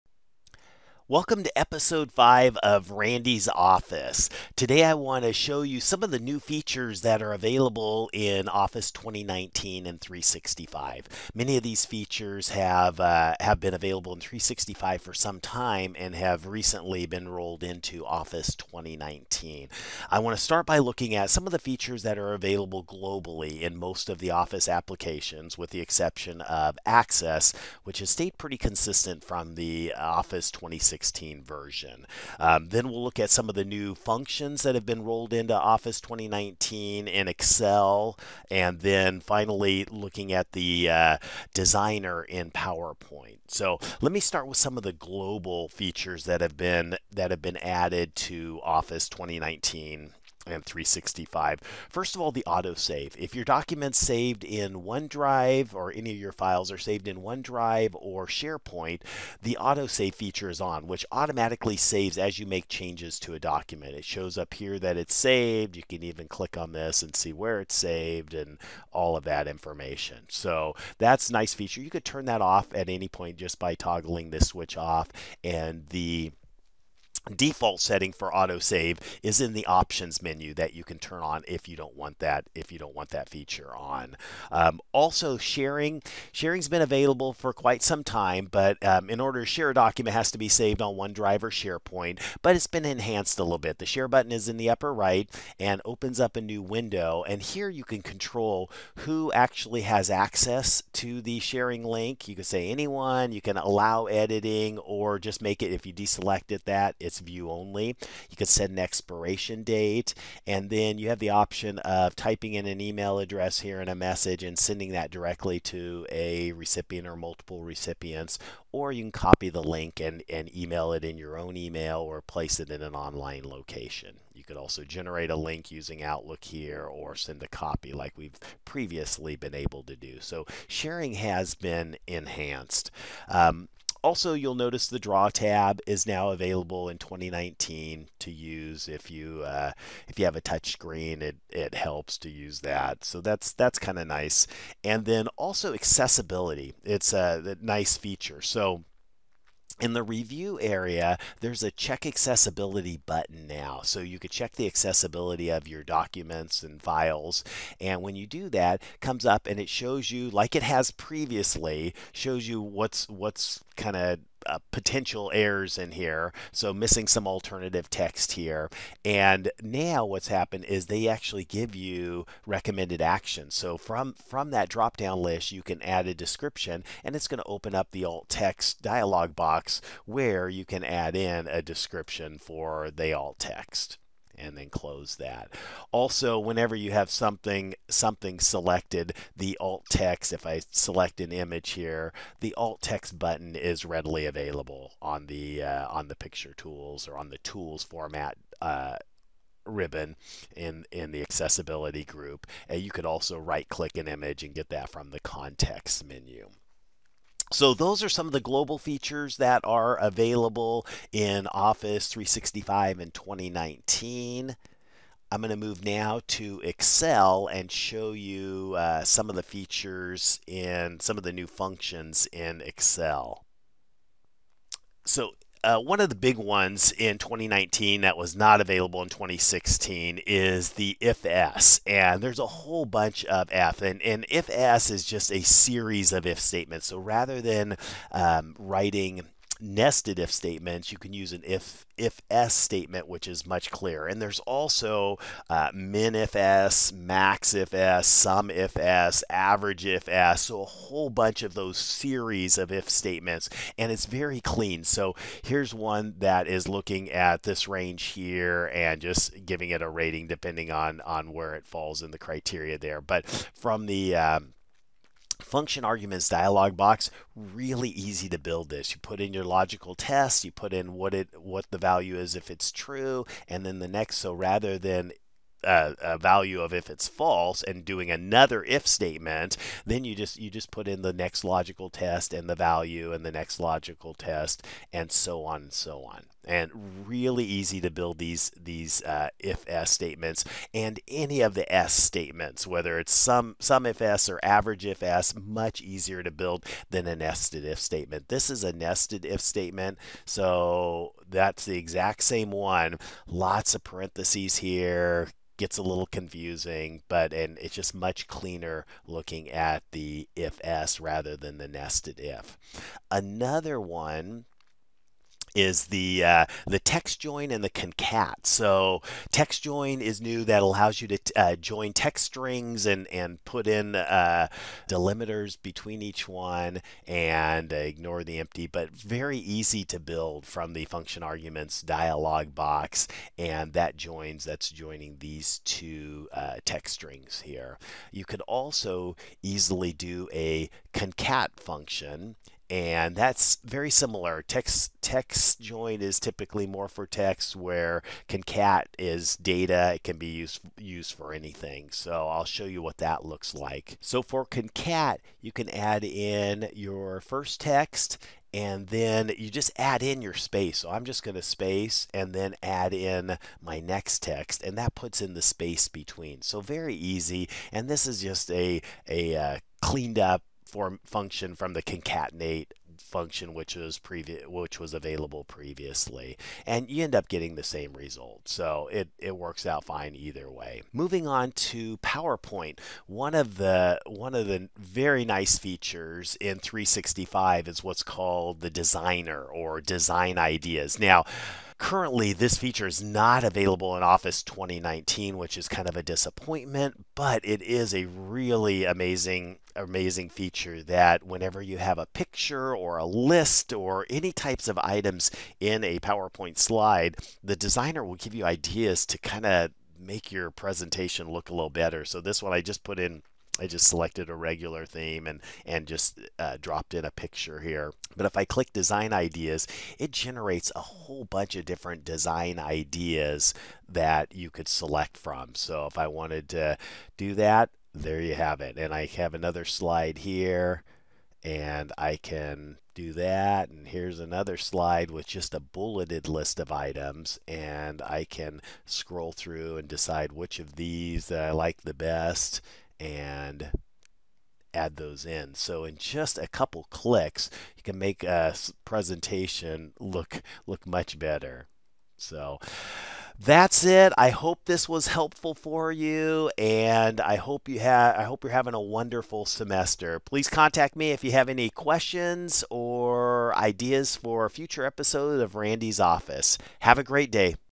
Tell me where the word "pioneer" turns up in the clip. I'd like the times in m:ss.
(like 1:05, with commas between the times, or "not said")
not said.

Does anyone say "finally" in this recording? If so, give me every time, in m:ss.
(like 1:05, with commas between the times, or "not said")
0:39.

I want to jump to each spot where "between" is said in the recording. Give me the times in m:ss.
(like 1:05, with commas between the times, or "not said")
5:25, 6:05.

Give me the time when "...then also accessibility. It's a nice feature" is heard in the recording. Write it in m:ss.
2:25.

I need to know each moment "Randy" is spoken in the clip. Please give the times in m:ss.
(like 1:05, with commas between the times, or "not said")
0:02, 7:45.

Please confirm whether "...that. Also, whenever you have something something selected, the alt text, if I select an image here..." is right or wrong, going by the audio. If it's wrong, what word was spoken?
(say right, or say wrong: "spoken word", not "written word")
right.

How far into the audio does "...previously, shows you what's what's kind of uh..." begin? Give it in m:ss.
2:40.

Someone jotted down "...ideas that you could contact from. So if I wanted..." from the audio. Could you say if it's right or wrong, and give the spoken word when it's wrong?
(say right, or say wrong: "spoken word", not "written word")
wrong: "select", not "contact".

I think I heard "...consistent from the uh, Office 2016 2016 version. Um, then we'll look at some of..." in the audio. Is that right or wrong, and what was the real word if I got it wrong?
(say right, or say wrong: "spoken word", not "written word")
right.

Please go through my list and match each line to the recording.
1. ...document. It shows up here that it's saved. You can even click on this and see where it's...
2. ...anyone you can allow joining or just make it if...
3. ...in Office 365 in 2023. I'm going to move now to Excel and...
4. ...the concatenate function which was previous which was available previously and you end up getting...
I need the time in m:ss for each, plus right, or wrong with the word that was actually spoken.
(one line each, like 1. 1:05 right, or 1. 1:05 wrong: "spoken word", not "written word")
1. 1:03 right
2. 1:42 wrong: "editing", not "joining"
3. 3:31 wrong: "2019", not "2023"
4. 6:11 right.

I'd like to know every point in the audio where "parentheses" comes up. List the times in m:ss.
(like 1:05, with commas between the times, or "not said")
5:03.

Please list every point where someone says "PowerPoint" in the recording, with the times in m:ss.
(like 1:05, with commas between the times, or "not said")
0:42, 6:21, 6:45.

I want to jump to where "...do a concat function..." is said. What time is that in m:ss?
5:39.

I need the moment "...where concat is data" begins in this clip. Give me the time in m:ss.
5:47.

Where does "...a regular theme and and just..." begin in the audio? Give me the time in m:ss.
6:54.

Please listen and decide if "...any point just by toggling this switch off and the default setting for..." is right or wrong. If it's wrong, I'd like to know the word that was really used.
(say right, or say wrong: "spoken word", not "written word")
right.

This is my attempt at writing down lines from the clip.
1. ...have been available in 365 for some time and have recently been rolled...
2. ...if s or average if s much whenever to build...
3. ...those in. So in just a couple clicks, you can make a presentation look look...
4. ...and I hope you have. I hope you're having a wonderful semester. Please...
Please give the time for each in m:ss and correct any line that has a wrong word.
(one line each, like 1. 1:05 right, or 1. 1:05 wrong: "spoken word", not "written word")
1. 0:13 right
2. 4:53 wrong: "easier", not "whenever"
3. 7:24 right
4. 7:36 right.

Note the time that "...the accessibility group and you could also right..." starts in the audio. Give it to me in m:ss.
3:21.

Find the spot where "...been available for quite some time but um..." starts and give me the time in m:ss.
1:26.